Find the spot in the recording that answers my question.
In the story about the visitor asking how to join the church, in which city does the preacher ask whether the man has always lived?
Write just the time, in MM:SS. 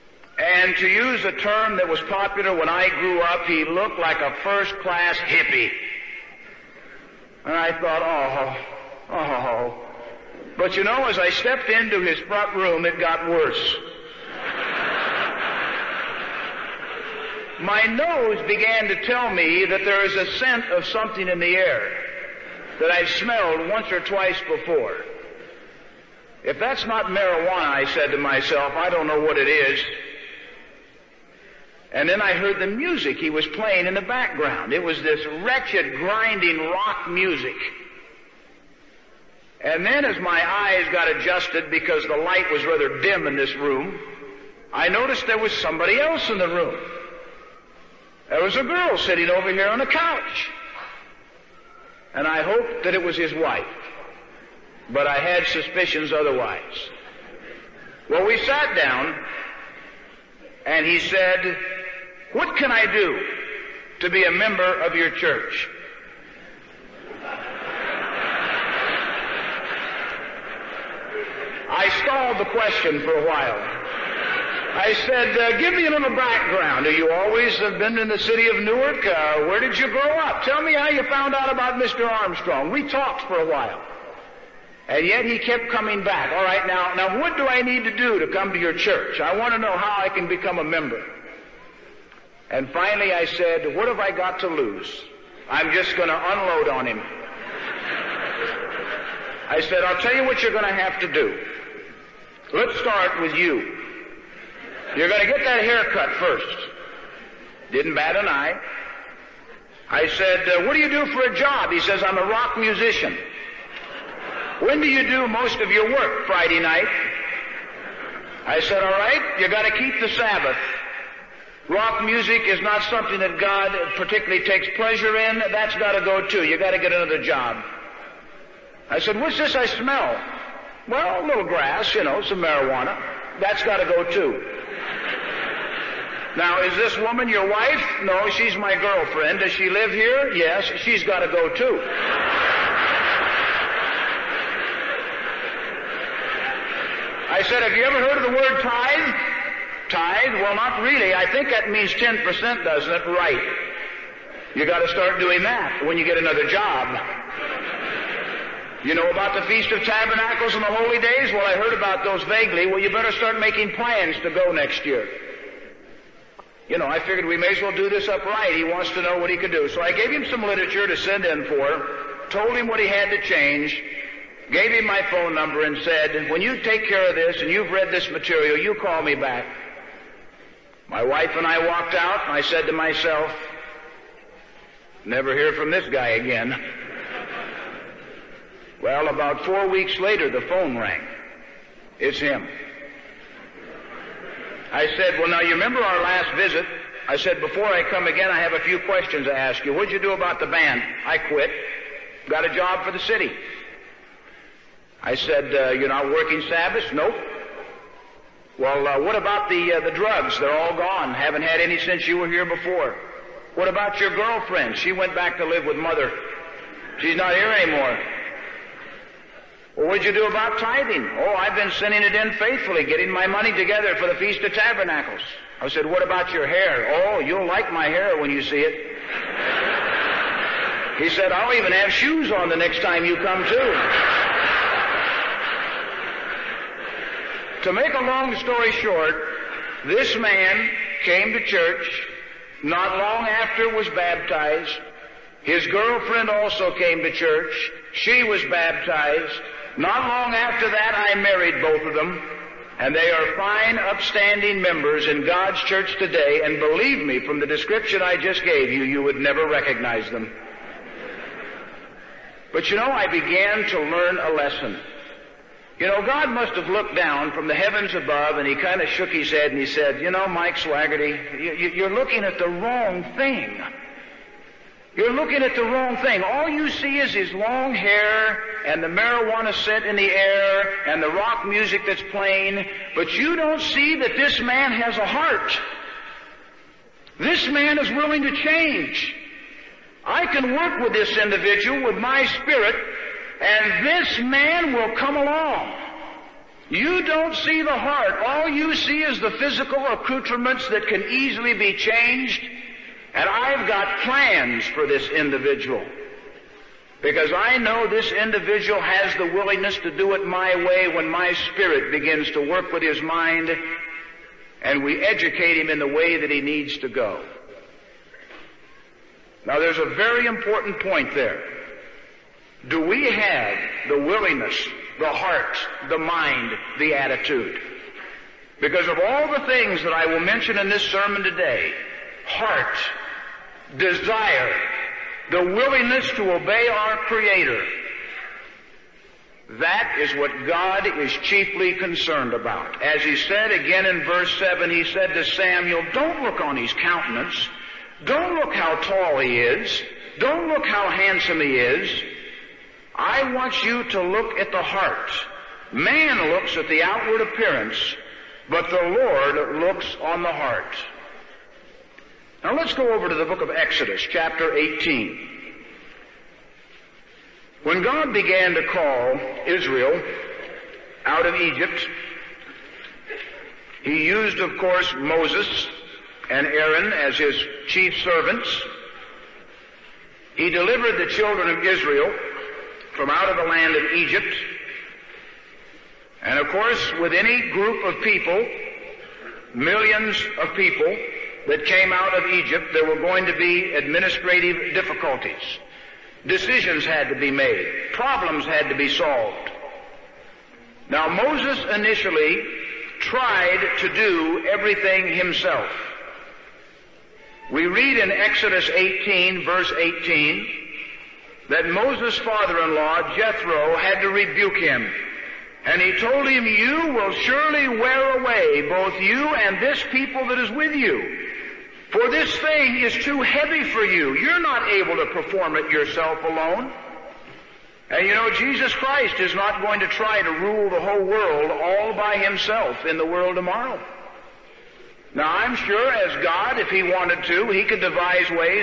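01:18.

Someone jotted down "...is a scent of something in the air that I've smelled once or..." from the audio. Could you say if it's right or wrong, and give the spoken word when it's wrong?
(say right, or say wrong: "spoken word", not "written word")
right.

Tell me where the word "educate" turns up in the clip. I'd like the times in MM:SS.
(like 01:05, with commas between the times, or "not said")
05:15.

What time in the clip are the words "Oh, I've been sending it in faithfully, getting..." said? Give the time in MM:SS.
03:41.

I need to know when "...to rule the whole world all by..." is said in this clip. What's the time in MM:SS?
07:10.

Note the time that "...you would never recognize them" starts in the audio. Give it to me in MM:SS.
04:18.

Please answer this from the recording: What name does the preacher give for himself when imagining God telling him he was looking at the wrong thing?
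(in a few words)
Mike Swagerty.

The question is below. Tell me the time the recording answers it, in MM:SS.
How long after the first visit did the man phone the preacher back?
03:09.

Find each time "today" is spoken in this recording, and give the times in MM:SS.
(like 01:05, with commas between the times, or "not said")
04:15, 05:31.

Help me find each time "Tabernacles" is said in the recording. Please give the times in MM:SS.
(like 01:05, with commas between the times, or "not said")
02:39, 03:44.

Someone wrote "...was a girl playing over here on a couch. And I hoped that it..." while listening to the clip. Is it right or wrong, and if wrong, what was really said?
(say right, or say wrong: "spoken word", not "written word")
wrong: "sitting", not "playing".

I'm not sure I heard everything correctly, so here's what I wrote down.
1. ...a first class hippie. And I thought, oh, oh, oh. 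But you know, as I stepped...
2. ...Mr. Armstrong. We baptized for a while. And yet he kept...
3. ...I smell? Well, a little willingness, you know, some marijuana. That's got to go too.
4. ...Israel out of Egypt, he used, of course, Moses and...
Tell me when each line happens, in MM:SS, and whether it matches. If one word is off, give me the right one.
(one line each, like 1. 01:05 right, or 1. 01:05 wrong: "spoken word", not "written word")
1. 00:04 right
2. 01:21 wrong: "talked", not "baptized"
3. 02:09 wrong: "grass", not "willingness"
4. 06:09 right.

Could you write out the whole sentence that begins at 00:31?
And then I heard the music he was playing in the background.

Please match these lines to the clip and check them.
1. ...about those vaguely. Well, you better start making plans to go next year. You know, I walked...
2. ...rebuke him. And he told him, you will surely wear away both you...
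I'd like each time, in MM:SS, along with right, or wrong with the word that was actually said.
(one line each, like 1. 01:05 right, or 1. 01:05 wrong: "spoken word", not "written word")
1. 02:41 wrong: "figured", not "walked"
2. 06:54 right.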